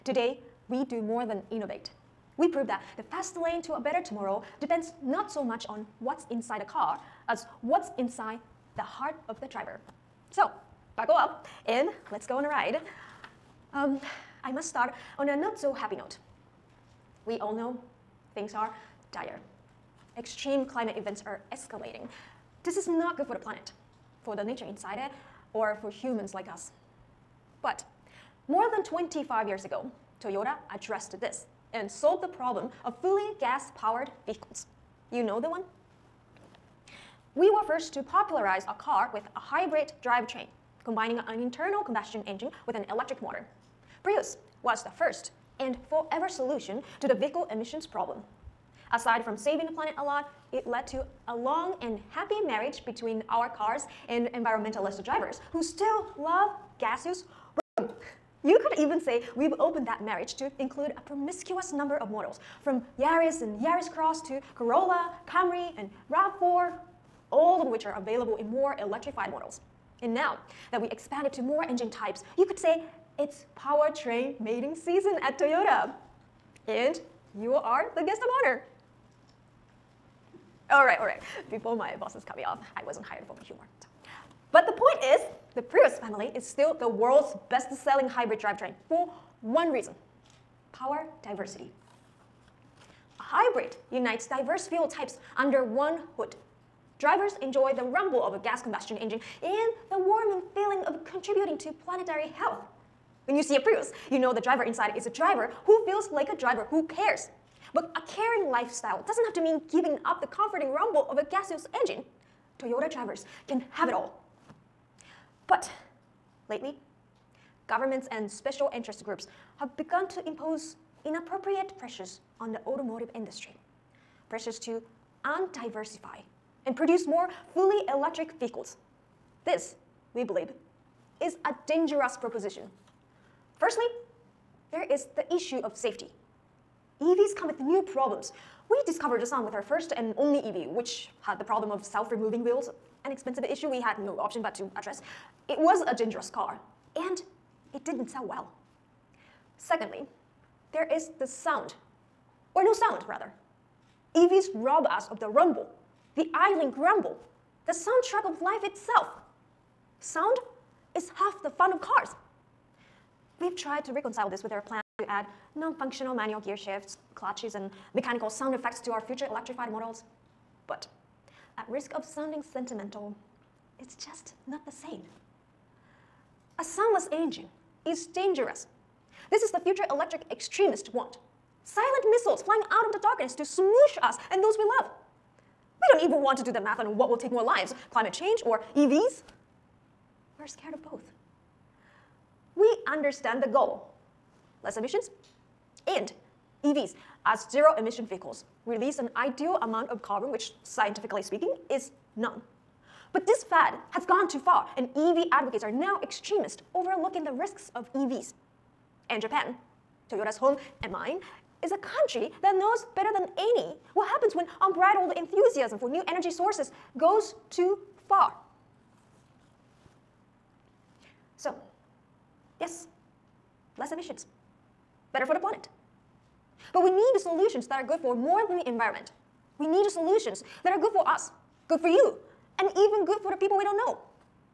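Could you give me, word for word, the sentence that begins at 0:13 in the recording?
Um, I must start on a not so happy note.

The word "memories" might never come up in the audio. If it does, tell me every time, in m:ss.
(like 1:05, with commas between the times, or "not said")
not said.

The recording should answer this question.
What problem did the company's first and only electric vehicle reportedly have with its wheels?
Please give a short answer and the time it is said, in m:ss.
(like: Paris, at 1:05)
self-removing wheels, at 2:21.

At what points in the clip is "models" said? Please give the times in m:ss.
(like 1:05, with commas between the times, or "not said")
1:02, 1:09, 2:49.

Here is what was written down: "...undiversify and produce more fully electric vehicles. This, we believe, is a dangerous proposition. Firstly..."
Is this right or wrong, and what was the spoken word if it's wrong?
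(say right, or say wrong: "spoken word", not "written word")
right.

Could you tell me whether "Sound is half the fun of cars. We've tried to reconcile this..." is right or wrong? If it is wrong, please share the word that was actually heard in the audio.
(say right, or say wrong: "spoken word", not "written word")
right.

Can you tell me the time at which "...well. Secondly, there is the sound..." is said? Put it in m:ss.
2:28.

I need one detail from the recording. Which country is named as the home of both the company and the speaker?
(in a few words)
Japan.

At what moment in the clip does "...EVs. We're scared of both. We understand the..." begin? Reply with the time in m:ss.
3:08.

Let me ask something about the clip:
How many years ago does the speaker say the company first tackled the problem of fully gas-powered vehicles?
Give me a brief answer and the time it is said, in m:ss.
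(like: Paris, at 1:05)
more than 25, at 0:28.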